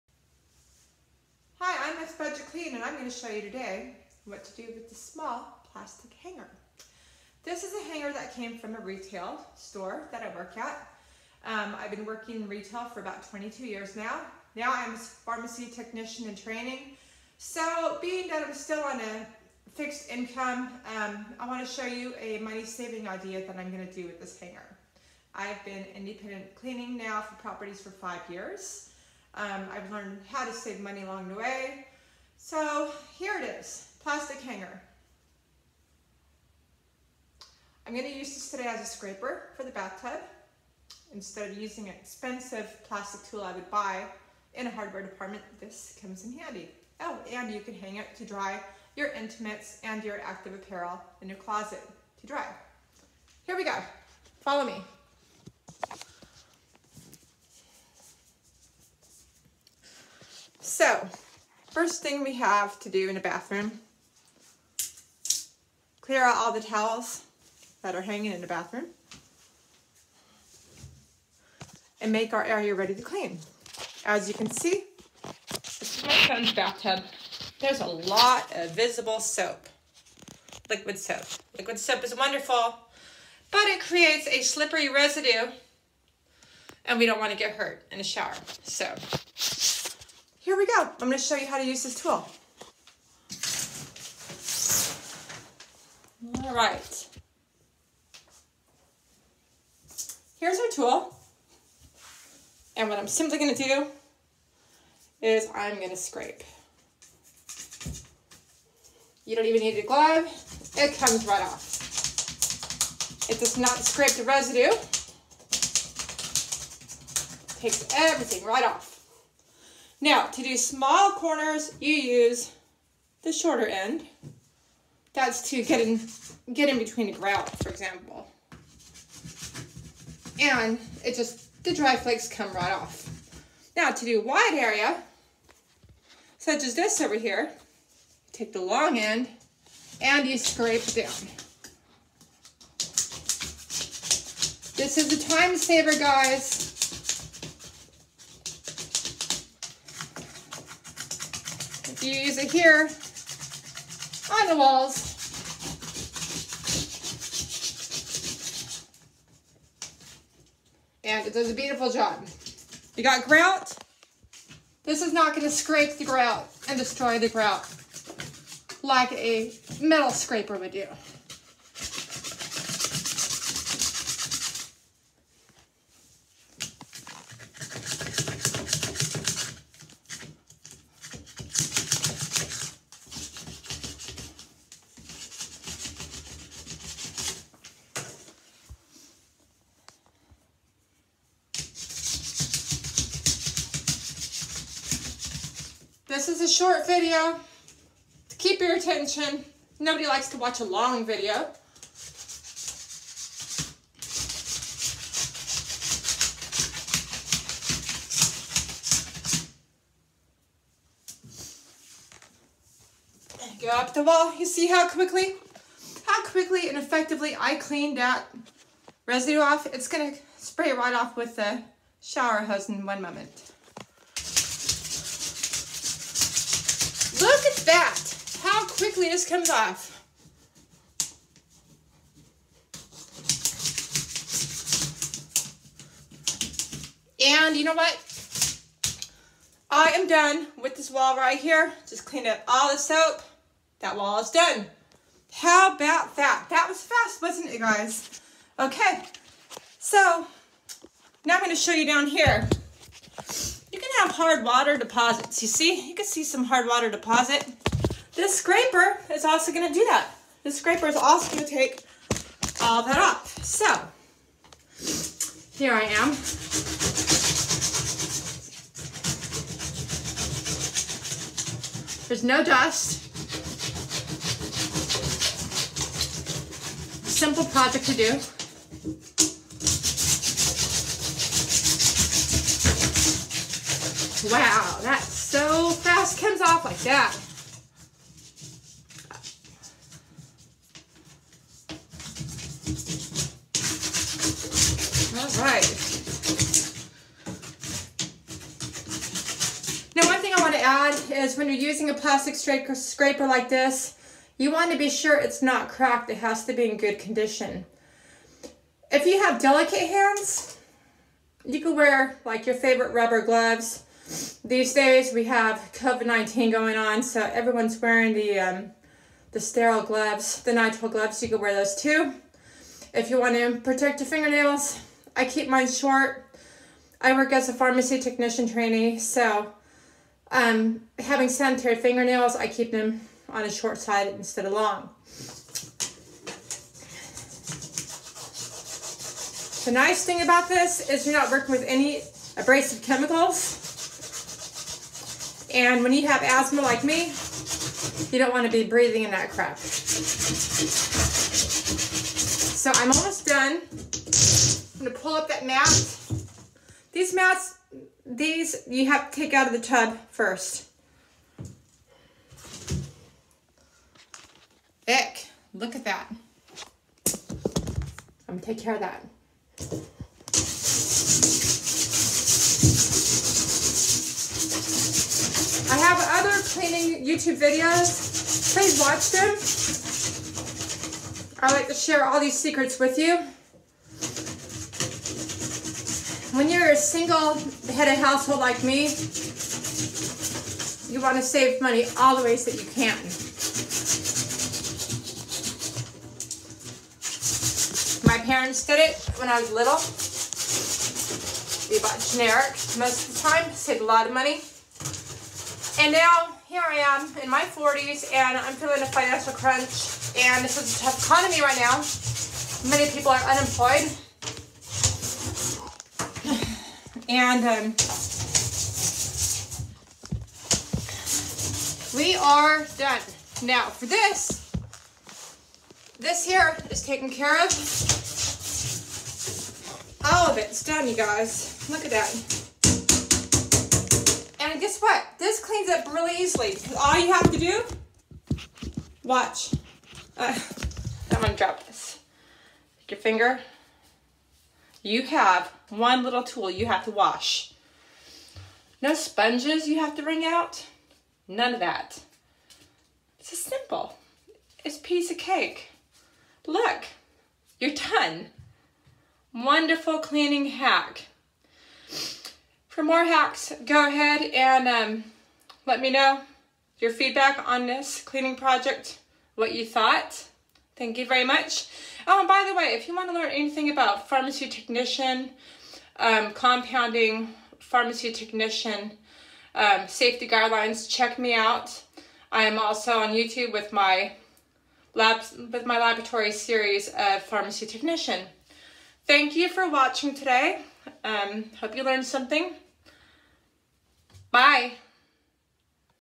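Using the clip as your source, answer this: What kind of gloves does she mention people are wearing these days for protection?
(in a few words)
Nitrile gloves.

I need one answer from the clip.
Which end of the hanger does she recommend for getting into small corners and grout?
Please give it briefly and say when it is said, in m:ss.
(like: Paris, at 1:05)
The shorter end, at 2:03.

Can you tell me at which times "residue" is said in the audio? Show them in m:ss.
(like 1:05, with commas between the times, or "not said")
1:24, 1:54, 3:39.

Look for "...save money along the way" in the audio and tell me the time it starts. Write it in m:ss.
0:30.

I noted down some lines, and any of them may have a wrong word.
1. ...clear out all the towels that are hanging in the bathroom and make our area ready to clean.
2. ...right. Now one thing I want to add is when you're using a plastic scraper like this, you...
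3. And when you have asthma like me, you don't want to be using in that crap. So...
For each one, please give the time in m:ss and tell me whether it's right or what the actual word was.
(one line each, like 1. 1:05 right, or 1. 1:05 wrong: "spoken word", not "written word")
1. 1:06 right
2. 4:55 right
3. 5:45 wrong: "breathing", not "using".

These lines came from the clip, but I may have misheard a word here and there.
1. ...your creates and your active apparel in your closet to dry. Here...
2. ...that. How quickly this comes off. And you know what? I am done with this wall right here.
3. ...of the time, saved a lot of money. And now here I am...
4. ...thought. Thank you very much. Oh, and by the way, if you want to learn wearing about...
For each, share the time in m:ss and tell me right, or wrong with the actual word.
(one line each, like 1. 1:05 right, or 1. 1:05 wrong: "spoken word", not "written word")
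1. 0:48 wrong: "intimates", not "creates"
2. 3:47 right
3. 6:43 right
4. 7:49 wrong: "anything", not "wearing".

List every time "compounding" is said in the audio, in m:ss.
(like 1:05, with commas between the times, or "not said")
7:56.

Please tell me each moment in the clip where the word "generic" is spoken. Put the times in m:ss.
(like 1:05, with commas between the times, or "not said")
6:42.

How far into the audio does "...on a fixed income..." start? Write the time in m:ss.
0:18.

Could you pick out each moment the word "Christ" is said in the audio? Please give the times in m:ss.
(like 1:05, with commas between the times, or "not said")
not said.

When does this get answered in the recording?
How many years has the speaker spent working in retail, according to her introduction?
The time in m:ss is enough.
0:13.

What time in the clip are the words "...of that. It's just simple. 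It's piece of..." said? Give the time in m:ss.
7:31.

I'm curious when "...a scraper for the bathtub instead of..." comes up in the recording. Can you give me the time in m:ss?
0:38.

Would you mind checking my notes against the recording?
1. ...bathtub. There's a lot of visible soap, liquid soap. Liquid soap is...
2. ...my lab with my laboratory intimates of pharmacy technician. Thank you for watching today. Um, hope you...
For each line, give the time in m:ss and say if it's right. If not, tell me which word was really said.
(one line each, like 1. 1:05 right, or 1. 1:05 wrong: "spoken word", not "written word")
1. 1:16 right
2. 8:03 wrong: "series", not "intimates".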